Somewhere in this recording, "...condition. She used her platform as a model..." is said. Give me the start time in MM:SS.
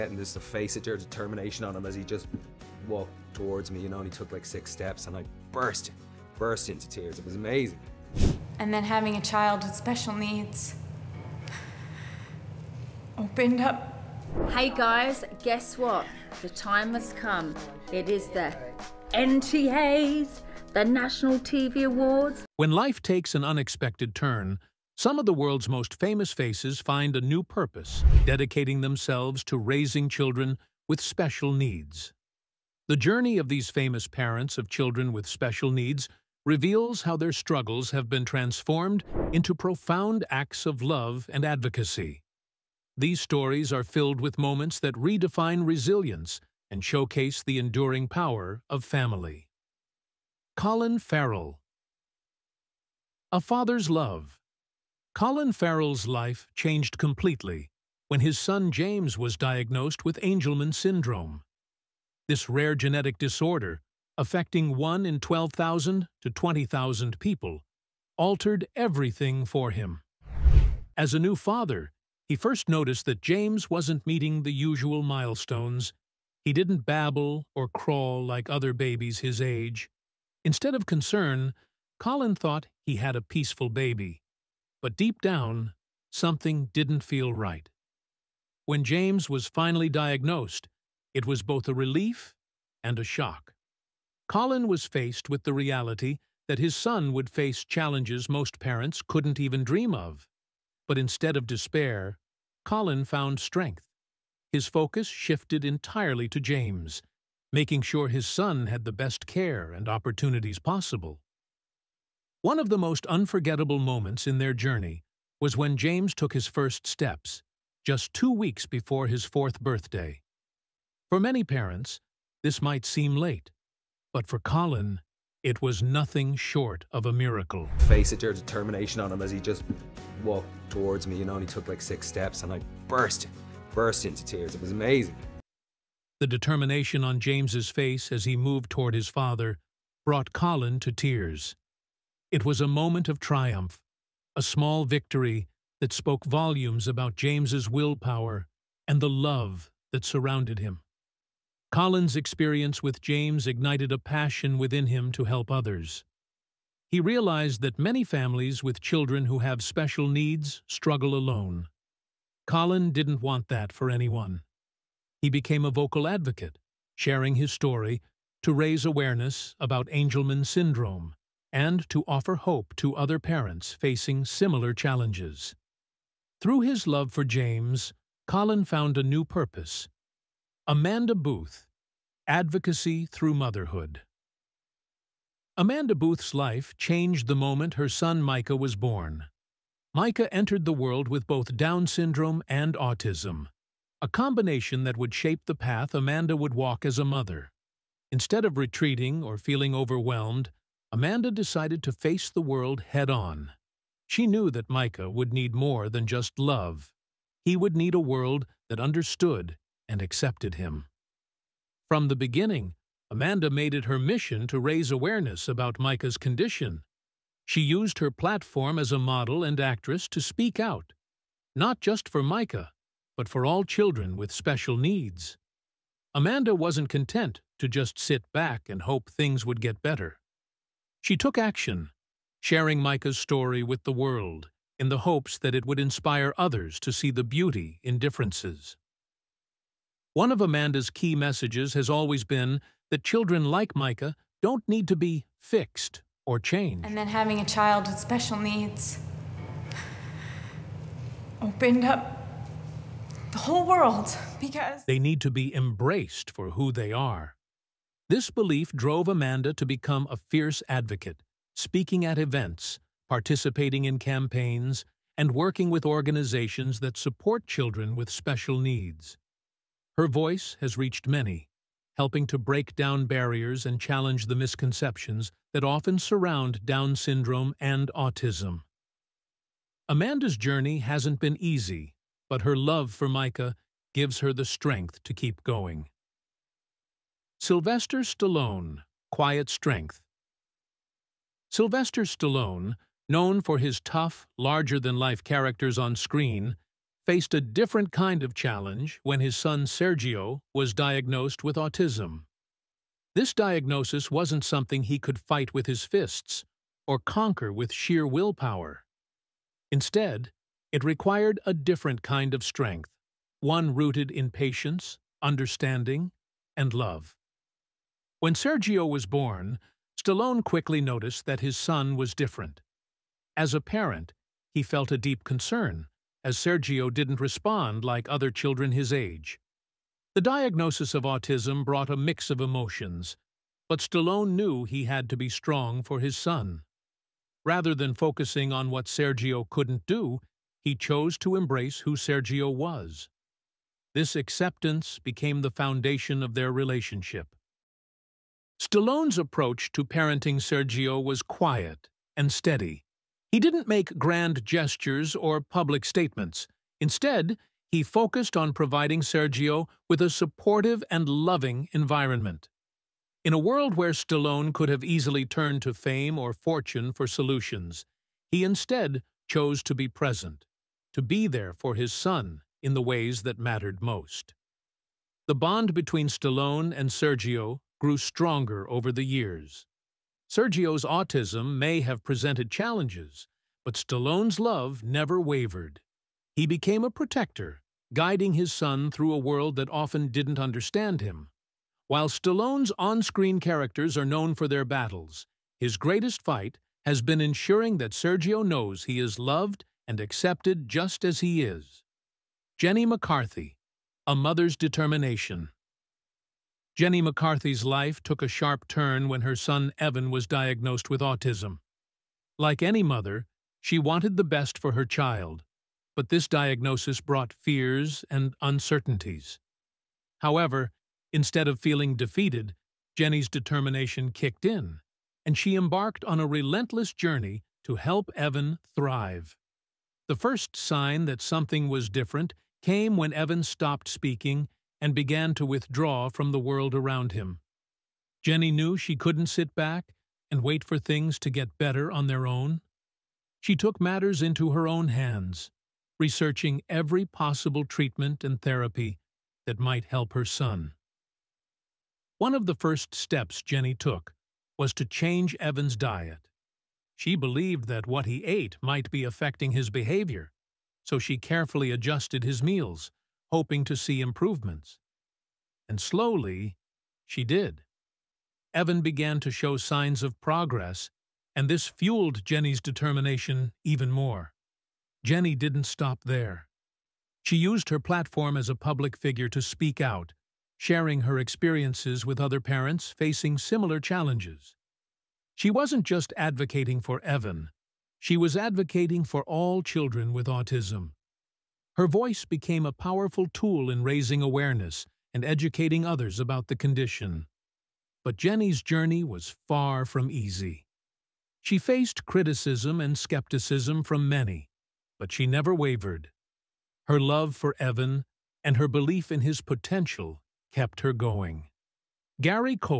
03:36.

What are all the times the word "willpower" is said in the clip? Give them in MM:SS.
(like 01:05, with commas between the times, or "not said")
02:27, 05:08.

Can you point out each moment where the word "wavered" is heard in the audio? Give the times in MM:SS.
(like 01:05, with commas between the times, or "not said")
06:25, 08:25.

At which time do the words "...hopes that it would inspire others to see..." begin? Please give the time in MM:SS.
03:54.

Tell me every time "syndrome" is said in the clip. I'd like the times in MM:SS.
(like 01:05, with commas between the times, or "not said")
01:00, 02:50, 03:11, 04:36.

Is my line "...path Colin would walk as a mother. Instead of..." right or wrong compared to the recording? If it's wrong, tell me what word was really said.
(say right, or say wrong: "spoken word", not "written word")
wrong: "Amanda", not "Colin".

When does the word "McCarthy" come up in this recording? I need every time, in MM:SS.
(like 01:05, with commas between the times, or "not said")
06:42, 06:47.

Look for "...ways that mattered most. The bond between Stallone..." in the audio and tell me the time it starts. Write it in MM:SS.
06:12.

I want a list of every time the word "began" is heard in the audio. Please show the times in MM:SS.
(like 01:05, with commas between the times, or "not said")
07:14, 07:48.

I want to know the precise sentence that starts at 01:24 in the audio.
But deep down, something didn't feel right.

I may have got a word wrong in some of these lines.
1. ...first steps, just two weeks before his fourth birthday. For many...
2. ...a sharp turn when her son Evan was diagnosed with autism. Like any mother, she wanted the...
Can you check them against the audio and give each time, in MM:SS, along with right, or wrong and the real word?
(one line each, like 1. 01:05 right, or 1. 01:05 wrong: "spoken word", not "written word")
1. 01:56 right
2. 06:48 right.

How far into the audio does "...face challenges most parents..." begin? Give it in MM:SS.
01:37.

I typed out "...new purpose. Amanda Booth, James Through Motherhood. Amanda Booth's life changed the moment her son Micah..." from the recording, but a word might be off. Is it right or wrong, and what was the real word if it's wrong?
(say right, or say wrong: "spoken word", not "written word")
wrong: "Advocacy", not "James".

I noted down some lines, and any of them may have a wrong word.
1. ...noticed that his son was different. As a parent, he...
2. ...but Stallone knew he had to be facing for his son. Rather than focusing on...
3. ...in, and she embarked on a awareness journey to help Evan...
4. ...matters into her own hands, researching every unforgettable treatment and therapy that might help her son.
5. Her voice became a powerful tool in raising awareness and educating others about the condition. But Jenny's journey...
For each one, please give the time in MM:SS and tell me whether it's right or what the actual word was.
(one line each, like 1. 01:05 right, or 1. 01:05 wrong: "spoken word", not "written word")
1. 05:20 right
2. 05:33 wrong: "strong", not "facing"
3. 07:04 wrong: "relentless", not "awareness"
4. 07:23 wrong: "possible", not "unforgettable"
5. 08:11 right.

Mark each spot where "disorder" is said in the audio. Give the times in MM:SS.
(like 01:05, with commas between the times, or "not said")
01:03.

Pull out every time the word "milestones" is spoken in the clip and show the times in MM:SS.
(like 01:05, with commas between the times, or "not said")
01:15.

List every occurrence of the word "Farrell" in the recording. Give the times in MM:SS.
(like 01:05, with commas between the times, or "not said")
00:50, 00:55.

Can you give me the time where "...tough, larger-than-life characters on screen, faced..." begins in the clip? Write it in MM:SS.
04:53.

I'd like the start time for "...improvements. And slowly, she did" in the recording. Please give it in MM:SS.
07:44.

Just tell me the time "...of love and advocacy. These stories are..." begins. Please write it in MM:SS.
00:40.